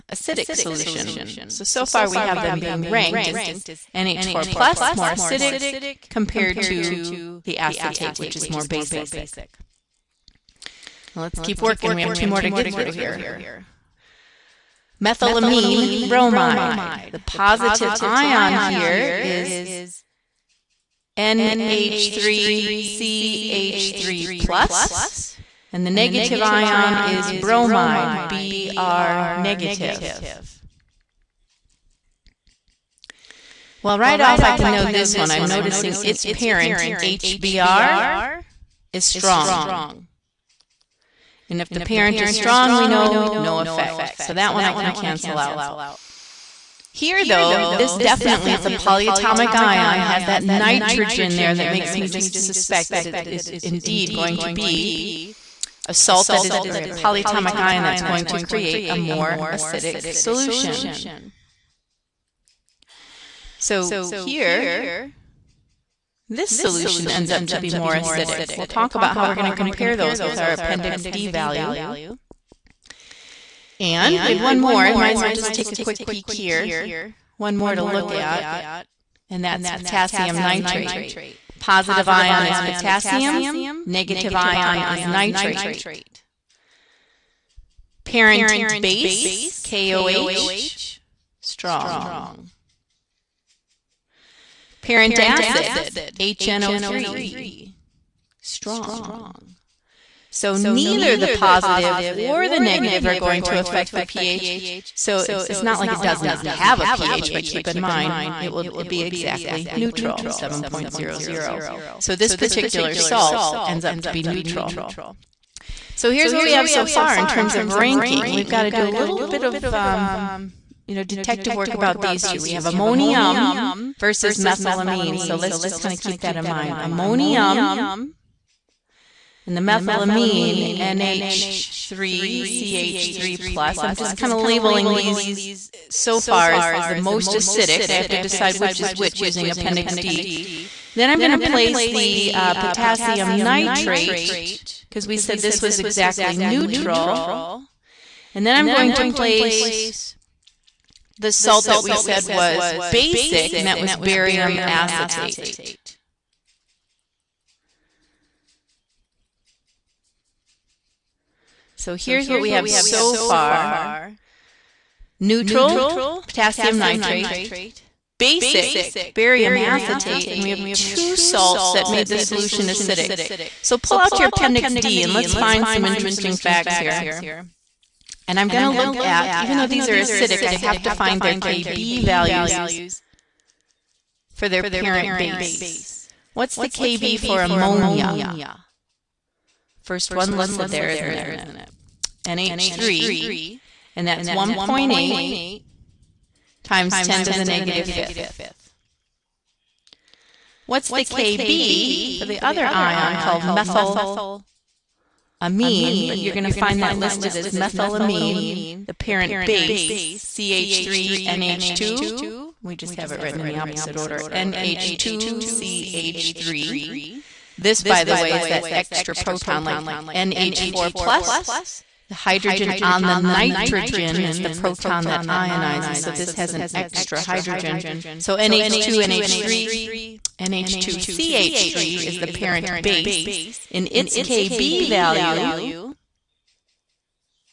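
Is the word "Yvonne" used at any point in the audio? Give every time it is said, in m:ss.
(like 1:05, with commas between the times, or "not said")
not said.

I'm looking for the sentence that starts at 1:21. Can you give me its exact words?
Positive ion is potassium, negative ion is nitrate.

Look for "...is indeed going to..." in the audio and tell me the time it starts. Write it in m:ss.
0:53.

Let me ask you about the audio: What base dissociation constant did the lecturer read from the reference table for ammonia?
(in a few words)
1.8 x 10^-5.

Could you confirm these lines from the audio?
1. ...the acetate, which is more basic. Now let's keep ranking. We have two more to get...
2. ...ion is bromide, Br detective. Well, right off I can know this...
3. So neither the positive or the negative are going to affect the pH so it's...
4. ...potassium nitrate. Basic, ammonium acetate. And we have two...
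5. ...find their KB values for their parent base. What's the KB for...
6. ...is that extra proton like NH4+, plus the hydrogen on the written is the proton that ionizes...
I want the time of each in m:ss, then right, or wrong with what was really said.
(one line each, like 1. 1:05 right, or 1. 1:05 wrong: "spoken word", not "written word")
1. 0:07 wrong: "working", not "ranking"
2. 0:26 wrong: "negative", not "detective"
3. 1:40 right
4. 2:46 wrong: "barium", not "ammonium"
5. 3:00 right
6. 3:38 wrong: "nitrogen", not "written".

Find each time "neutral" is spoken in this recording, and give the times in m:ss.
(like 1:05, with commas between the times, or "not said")
1:49, 1:54, 2:26, 2:45.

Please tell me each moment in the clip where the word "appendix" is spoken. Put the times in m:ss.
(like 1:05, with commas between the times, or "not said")
1:10, 2:19, 2:54.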